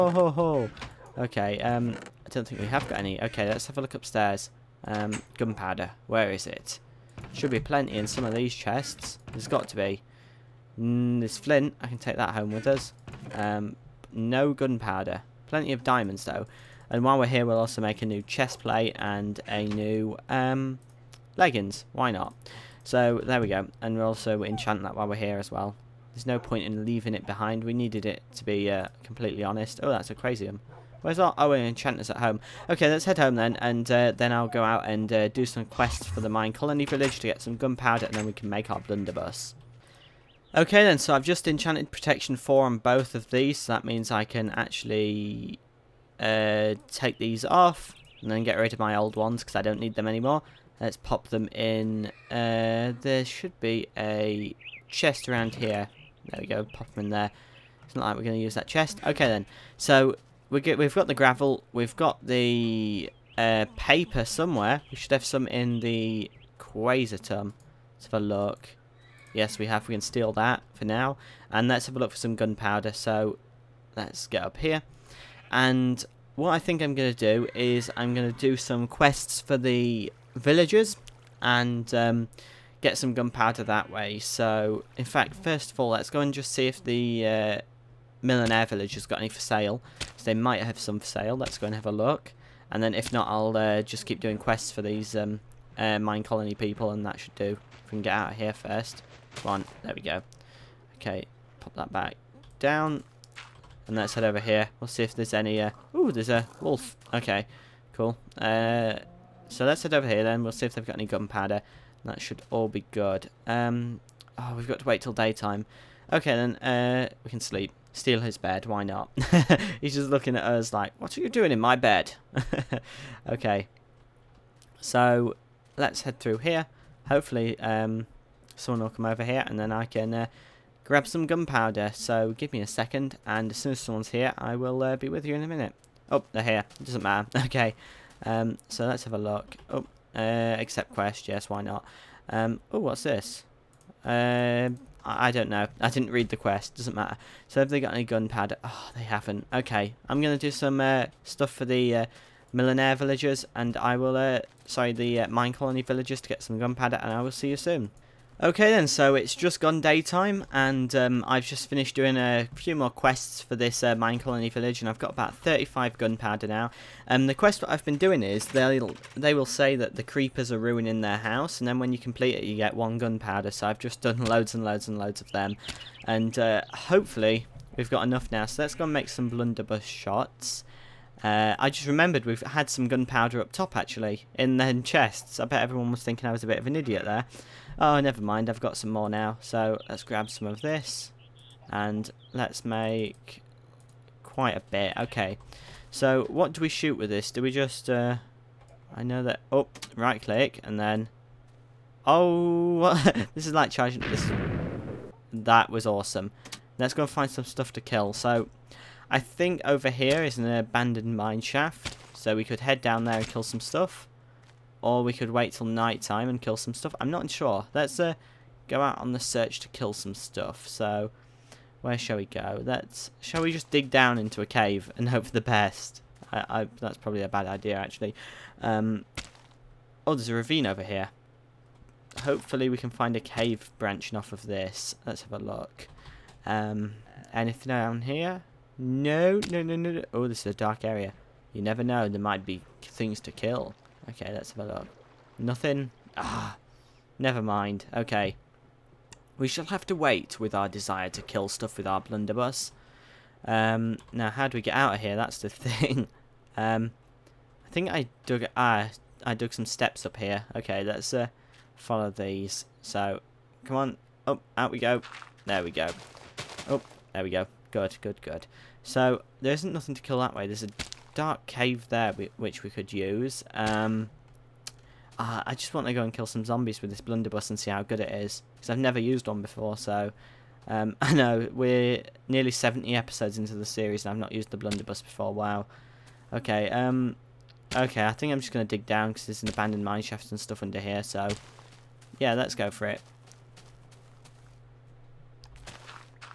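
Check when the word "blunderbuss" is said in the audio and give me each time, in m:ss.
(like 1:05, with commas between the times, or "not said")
0:38, 2:59, 4:11, 4:36, 4:44.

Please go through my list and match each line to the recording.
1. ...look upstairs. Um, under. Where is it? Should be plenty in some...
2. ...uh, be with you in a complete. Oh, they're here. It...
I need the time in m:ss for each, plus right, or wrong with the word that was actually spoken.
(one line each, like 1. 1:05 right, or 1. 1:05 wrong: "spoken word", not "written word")
1. 0:03 wrong: "gunpowder", not "under"
2. 2:14 wrong: "minute", not "complete".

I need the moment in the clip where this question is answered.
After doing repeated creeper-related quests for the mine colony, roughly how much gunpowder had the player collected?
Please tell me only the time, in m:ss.
2:45.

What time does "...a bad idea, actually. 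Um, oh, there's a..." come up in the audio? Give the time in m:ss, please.
3:47.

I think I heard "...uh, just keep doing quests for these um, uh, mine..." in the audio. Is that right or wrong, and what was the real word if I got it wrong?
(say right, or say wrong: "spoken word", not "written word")
right.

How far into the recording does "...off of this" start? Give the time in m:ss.
3:54.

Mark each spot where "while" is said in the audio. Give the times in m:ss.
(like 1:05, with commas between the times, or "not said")
0:17, 0:24.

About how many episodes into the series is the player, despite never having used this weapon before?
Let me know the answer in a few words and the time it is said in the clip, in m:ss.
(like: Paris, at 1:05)
70, at 4:42.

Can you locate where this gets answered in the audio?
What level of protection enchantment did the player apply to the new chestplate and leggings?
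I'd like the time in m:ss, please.
0:41.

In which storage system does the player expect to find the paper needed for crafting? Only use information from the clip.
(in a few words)
Quasitum.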